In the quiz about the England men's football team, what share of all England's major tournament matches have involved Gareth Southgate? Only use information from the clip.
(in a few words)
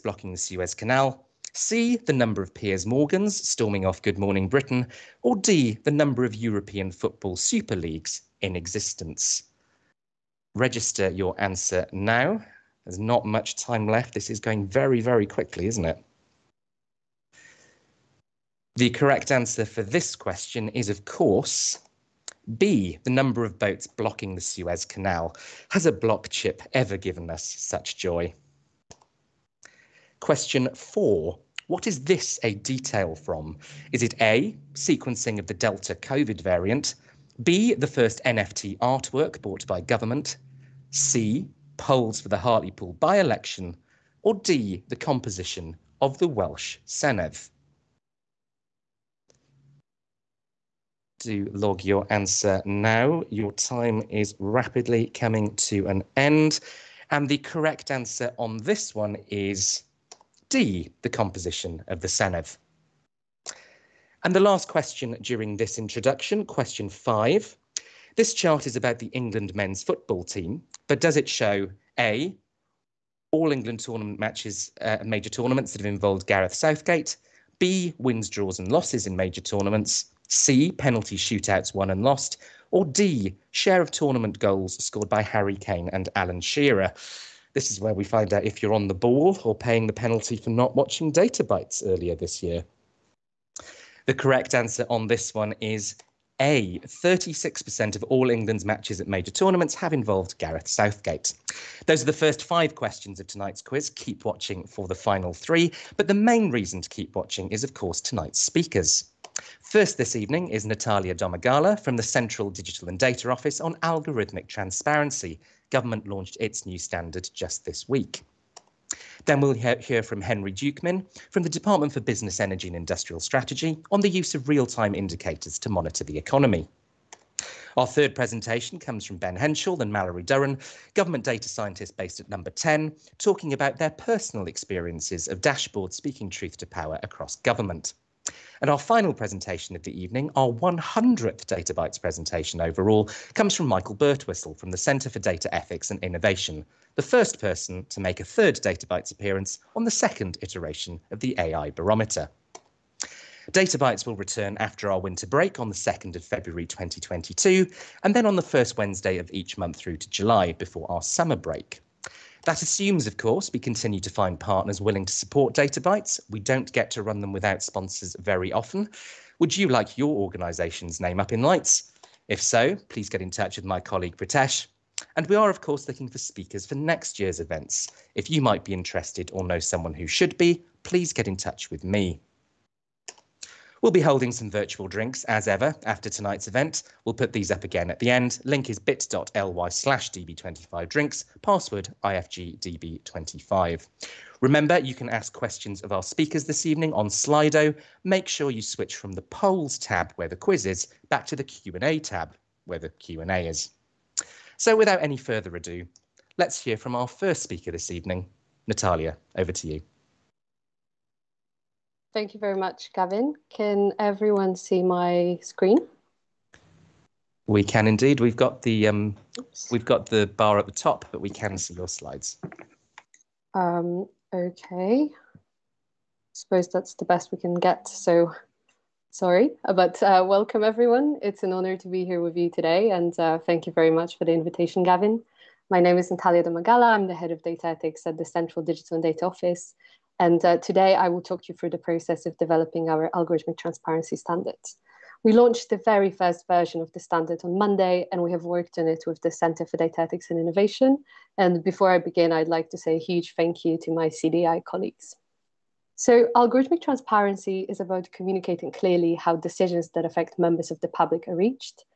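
36%.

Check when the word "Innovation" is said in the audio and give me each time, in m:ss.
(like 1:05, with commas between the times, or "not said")
2:26, 4:10.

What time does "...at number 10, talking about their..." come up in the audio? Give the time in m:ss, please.
2:12.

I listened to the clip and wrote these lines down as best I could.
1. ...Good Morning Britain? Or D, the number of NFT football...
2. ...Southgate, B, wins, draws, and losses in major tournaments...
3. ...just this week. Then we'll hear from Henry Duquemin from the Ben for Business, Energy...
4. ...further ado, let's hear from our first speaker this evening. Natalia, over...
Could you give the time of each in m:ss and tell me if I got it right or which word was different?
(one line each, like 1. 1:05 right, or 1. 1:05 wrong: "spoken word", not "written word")
1. 0:04 wrong: "European", not "NFT"
2. 1:16 right
3. 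1:57 wrong: "Department", not "Ben"
4. 3:25 right.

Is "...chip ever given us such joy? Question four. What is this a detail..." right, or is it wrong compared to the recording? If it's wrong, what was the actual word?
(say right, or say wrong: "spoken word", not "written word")
right.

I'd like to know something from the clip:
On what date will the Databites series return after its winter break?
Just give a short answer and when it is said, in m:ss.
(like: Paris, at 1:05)
2 February 2022, at 2:35.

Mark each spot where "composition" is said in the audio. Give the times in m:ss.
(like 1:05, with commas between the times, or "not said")
0:44, 1:01.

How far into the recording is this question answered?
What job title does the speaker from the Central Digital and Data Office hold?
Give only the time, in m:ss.
3:57.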